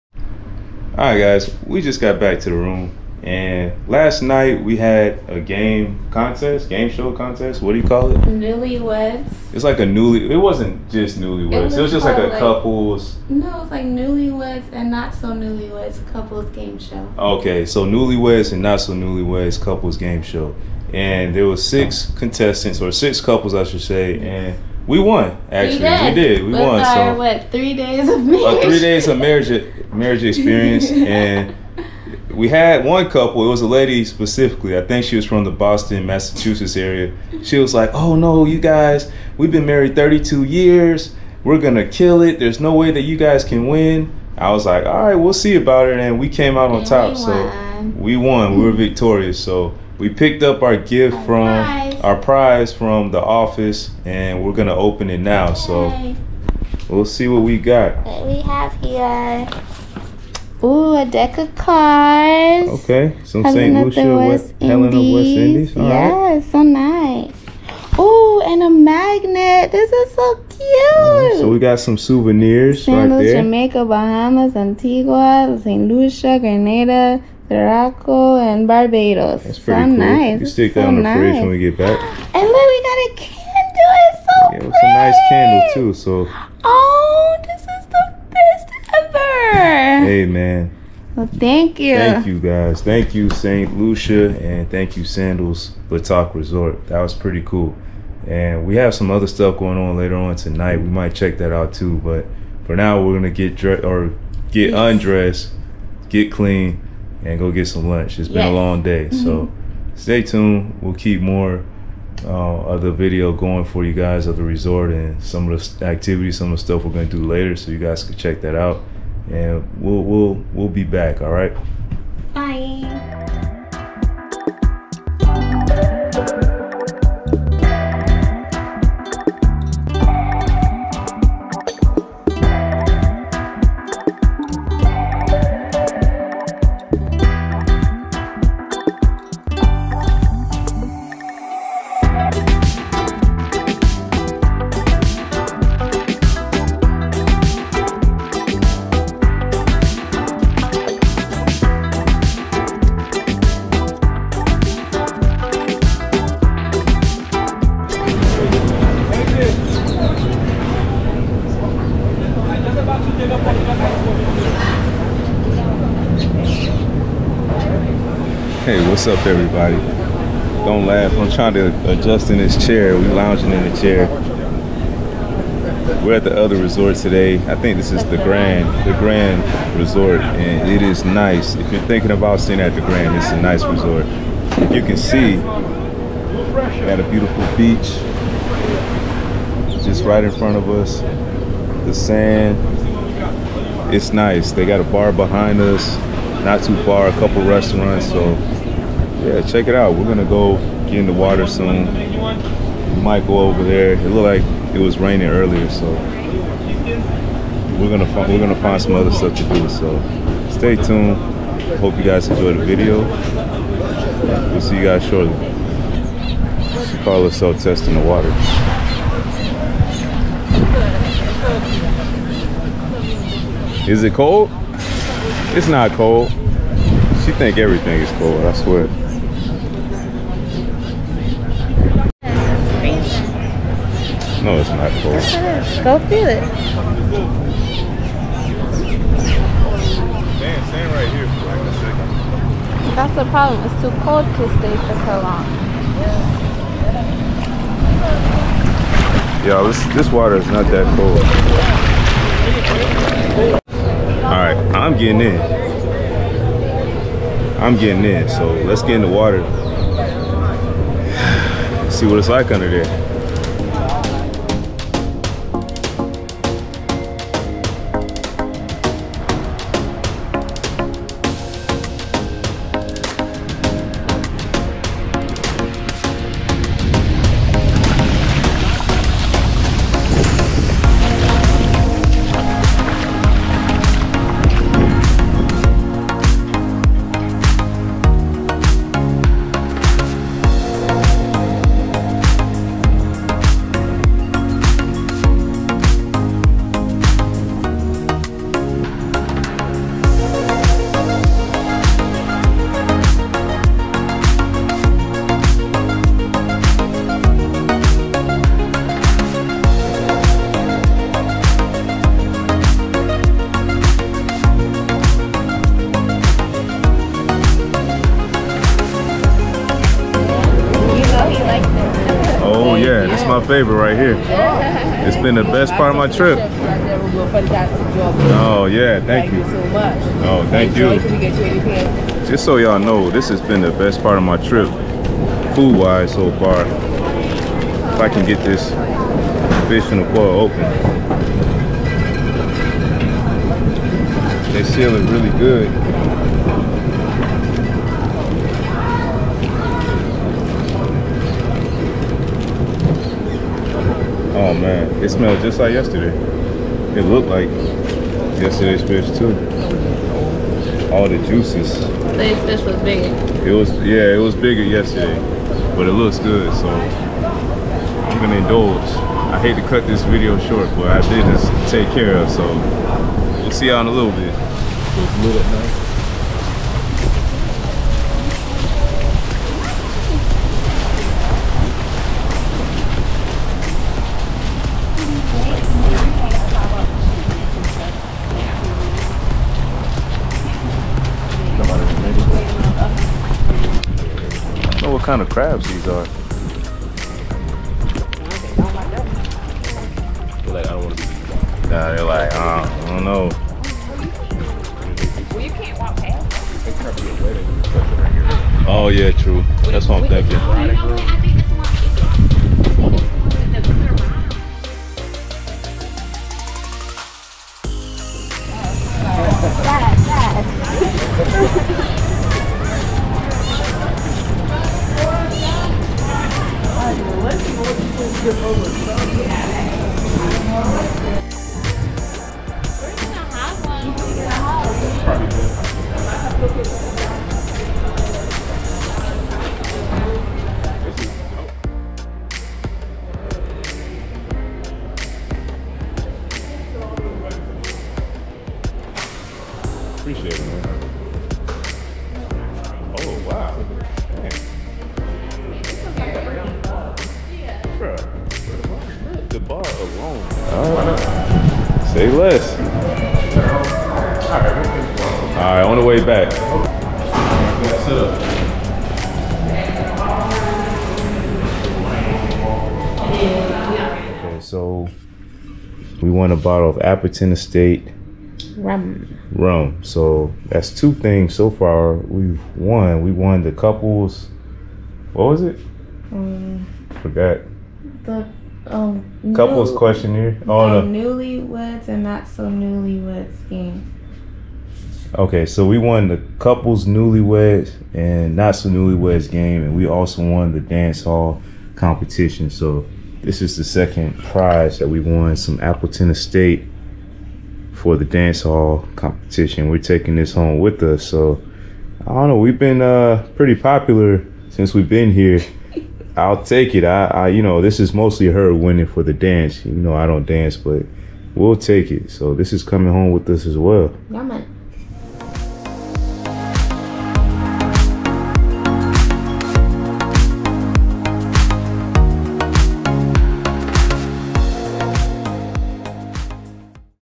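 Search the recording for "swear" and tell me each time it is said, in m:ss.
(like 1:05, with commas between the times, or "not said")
3:48.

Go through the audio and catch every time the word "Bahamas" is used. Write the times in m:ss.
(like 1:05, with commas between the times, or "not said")
1:13.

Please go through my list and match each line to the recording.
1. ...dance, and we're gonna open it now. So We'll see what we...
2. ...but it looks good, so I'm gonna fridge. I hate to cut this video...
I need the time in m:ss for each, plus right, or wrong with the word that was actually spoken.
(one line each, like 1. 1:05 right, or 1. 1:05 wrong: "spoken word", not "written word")
1. 0:53 wrong: "office", not "dance"
2. 6:05 wrong: "indulge", not "fridge".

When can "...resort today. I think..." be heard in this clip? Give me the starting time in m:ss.
2:56.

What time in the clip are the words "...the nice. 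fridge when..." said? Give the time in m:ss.
1:20.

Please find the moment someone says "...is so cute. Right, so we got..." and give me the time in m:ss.
1:09.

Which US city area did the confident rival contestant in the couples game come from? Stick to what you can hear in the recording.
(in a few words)
Boston.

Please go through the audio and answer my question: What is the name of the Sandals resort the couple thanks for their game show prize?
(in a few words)
La Toc.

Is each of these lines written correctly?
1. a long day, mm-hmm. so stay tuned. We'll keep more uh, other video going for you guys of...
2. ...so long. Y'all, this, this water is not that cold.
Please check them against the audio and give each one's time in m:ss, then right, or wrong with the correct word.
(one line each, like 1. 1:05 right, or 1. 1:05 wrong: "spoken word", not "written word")
1. 1:48 right
2. 4:05 right.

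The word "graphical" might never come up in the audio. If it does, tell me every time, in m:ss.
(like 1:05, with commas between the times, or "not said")
not said.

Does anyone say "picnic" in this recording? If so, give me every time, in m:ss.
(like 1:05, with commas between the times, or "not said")
not said.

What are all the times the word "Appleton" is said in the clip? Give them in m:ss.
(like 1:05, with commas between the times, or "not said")
7:56, 8:25.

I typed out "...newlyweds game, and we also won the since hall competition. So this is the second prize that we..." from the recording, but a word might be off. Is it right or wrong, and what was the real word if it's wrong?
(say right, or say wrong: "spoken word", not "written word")
wrong: "dance", not "since".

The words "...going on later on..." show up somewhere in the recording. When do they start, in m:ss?
1:39.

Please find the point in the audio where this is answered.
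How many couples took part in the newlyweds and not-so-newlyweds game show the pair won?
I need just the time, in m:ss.
0:21.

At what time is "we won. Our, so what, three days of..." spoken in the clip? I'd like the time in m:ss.
0:26.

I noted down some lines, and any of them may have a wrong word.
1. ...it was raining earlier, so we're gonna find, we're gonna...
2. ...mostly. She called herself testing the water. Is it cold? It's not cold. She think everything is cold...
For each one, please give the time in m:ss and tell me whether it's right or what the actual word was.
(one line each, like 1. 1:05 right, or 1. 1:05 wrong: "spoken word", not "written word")
1. 3:24 right
2. 3:35 wrong: "shortly", not "mostly".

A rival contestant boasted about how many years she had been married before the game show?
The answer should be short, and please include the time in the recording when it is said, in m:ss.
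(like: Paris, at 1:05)
32, at 0:39.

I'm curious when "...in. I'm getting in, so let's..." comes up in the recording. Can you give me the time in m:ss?
4:15.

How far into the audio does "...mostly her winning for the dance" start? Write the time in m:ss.
8:37.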